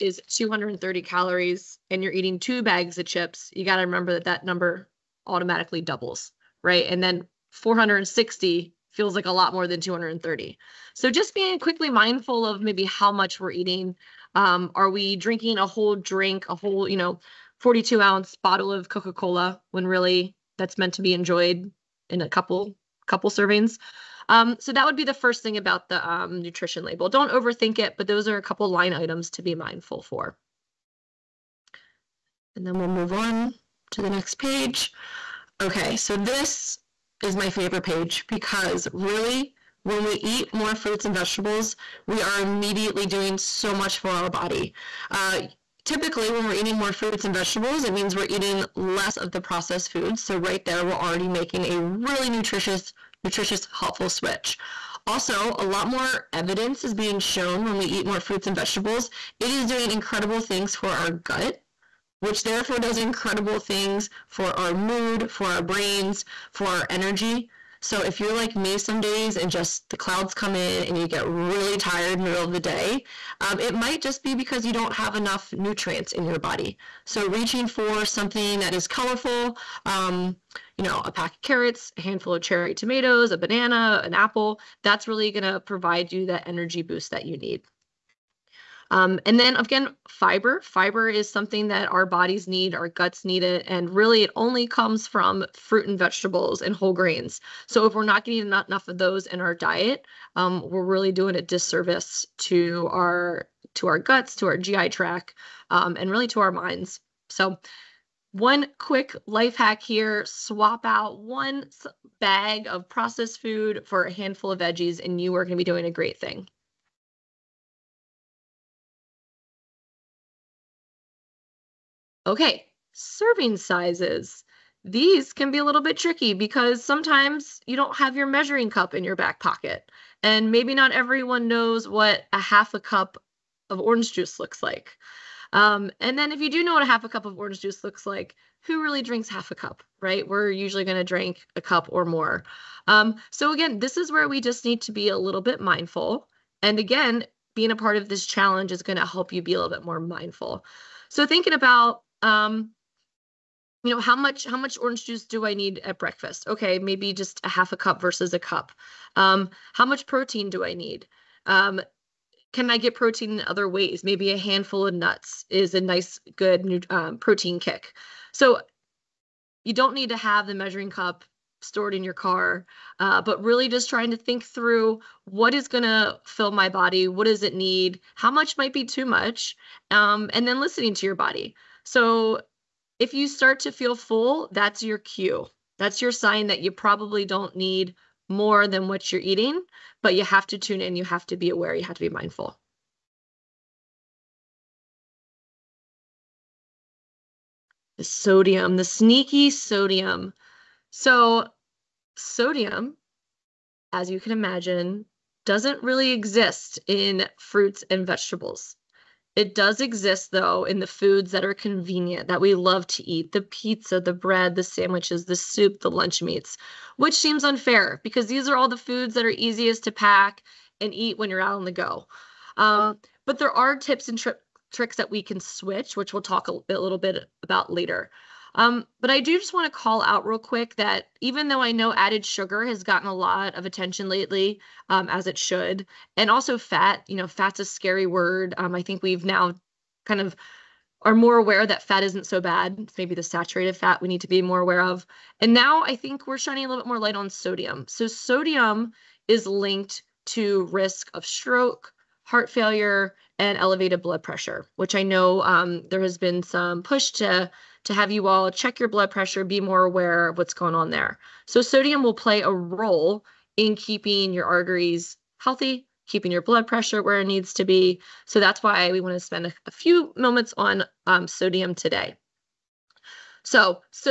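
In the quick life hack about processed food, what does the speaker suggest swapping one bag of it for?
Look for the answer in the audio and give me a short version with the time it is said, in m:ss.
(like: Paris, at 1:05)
a handful of veggies, at 1:54.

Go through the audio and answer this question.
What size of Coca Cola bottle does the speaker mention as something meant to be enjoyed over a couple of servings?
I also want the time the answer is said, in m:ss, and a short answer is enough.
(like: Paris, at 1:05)
42 ounce, at 0:17.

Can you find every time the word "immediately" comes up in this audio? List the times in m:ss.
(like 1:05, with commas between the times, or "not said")
0:42.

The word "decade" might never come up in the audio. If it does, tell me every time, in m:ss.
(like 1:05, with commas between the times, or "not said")
not said.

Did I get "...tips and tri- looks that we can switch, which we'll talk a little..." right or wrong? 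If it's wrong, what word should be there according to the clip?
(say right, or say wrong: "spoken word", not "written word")
wrong: "tricks", not "looks".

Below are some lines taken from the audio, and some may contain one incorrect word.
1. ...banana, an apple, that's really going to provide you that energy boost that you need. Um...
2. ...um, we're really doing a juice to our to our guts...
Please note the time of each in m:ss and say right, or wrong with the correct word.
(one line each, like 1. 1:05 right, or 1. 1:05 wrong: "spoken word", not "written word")
1. 1:23 right
2. 1:40 wrong: "disservice", not "juice".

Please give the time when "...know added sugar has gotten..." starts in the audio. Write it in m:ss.
3:51.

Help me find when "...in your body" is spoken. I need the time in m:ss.
1:16.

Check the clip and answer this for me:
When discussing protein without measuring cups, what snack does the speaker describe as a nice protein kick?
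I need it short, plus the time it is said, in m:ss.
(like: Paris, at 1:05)
a handful of nuts, at 2:44.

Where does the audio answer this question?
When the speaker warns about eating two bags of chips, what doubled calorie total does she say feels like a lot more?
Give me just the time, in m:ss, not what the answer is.
0:07.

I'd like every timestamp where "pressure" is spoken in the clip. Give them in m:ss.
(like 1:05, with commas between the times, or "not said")
4:14, 4:19, 4:26.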